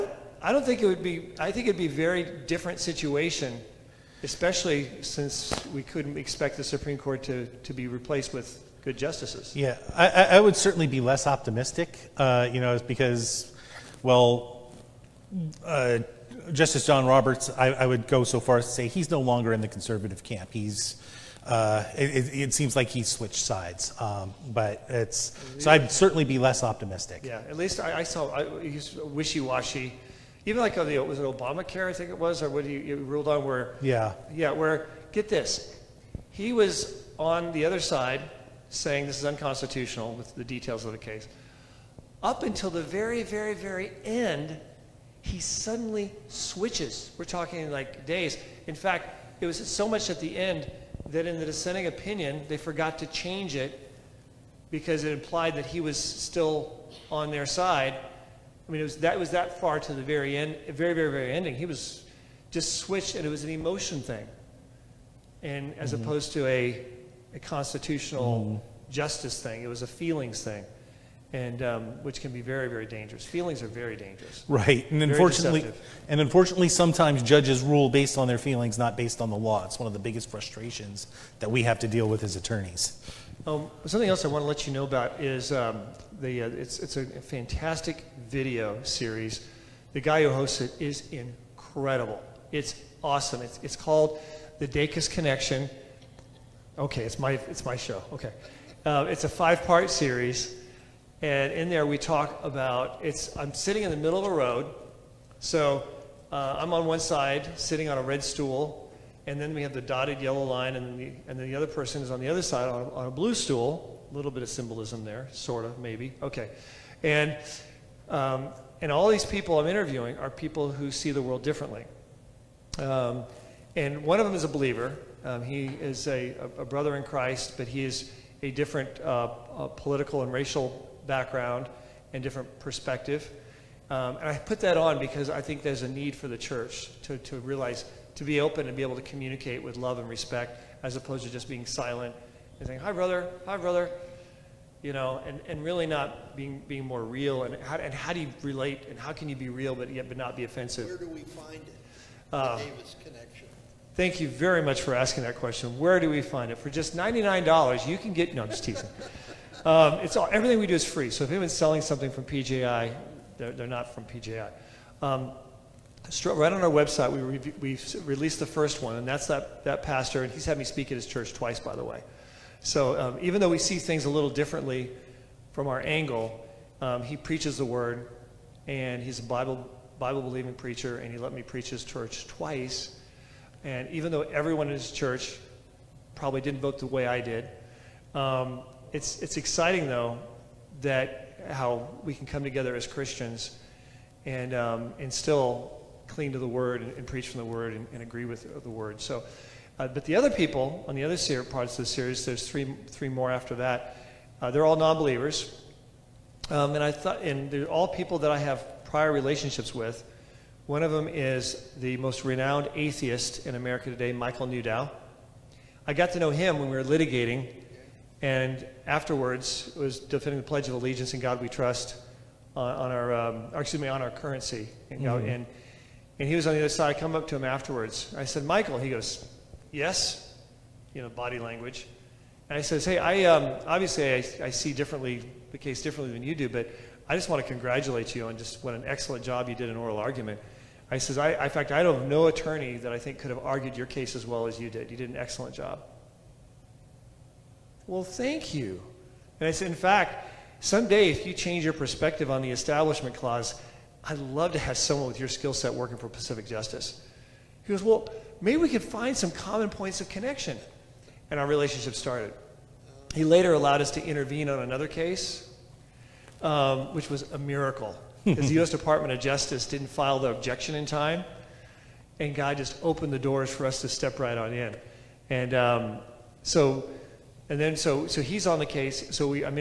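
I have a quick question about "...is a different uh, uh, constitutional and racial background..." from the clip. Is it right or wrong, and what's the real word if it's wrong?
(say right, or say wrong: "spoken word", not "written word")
wrong: "political", not "constitutional".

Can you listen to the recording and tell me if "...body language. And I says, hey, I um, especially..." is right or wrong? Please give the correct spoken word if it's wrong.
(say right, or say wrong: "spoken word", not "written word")
wrong: "obviously", not "especially".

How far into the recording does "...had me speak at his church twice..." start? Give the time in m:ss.
2:50.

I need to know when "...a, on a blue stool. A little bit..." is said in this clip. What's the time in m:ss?
1:52.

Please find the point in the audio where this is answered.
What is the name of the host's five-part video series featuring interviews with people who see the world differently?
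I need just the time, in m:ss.
1:34.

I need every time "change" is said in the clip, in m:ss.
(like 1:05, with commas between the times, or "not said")
0:53, 4:11.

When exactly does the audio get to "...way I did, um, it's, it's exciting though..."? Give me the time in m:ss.
3:06.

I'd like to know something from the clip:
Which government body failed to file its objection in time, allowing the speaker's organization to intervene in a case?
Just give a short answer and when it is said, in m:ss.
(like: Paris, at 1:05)
U.S. Department of Justice, at 4:28.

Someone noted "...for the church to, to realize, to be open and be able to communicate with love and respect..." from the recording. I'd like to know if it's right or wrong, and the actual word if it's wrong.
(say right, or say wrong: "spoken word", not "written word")
right.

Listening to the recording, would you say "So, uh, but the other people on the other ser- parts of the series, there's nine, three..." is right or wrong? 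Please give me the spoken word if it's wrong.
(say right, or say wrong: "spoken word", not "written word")
wrong: "three", not "nine".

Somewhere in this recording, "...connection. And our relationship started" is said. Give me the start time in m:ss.
4:20.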